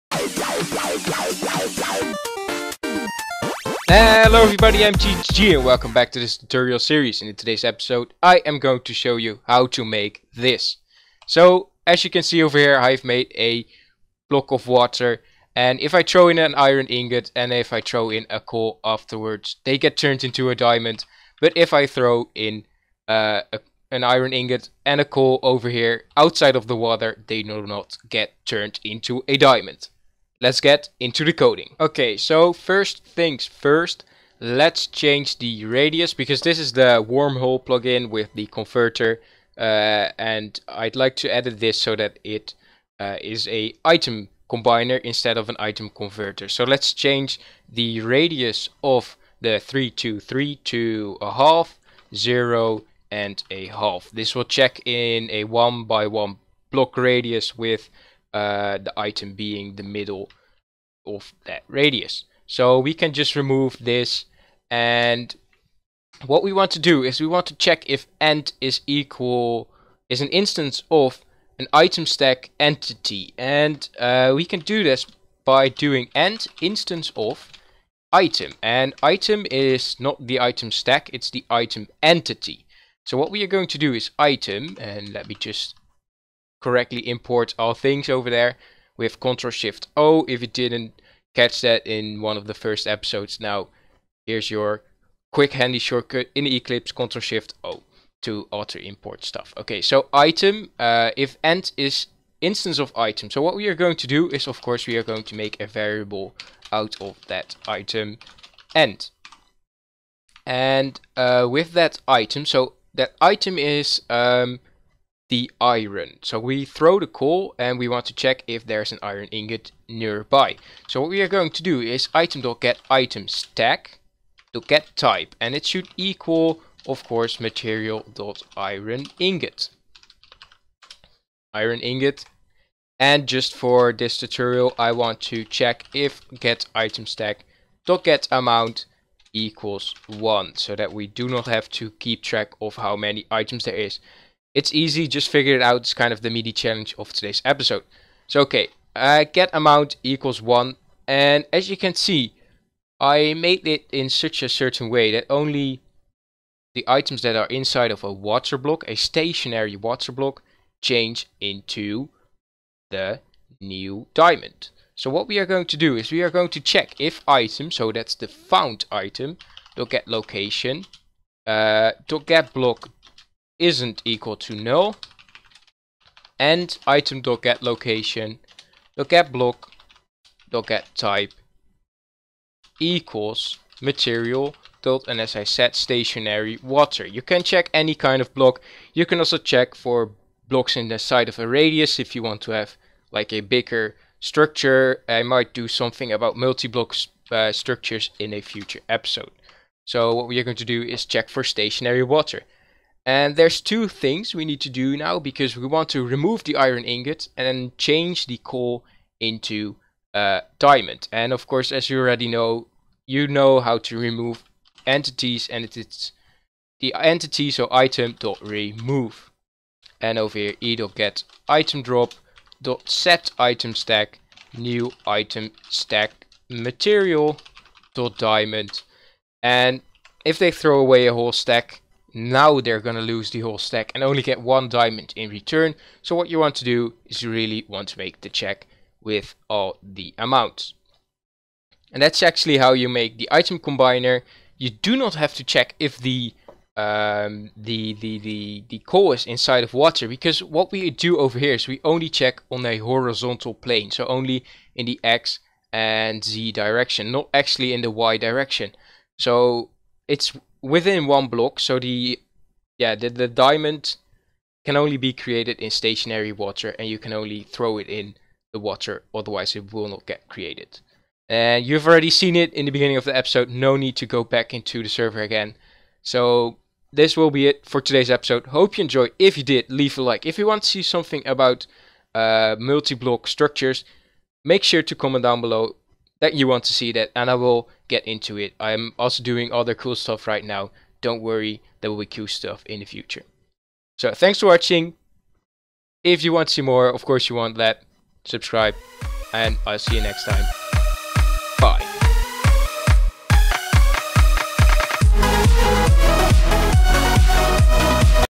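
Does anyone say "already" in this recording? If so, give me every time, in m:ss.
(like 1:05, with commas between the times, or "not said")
3:31, 4:31.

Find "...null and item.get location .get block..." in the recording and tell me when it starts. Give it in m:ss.
2:54.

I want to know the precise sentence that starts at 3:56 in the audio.
So what you want to do is you really want to make the check with all the amounts.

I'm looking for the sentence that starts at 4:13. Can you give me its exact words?
So only in the X and Z direction, not actually in the Y direction.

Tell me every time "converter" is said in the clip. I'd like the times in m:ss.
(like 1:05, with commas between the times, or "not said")
0:38, 0:45.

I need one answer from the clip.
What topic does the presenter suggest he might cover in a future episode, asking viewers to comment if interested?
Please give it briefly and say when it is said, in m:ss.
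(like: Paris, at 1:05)
Multi-block structures, at 3:16.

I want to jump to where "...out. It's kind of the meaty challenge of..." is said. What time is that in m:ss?
2:25.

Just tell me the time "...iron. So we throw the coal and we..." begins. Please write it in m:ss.
1:55.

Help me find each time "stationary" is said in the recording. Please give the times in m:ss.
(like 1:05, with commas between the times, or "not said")
2:38, 3:05, 3:21, 4:25.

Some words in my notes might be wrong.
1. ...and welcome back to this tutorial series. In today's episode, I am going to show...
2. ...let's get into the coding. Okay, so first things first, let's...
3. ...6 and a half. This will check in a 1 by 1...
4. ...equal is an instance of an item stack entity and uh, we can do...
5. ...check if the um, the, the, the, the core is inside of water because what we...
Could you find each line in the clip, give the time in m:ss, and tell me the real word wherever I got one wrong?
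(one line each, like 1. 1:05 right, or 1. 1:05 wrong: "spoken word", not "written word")
1. 0:05 right
2. 0:30 right
3. 0:52 wrong: "0", not "6"
4. 1:08 right
5. 4:05 right.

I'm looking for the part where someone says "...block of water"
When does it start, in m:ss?
0:14.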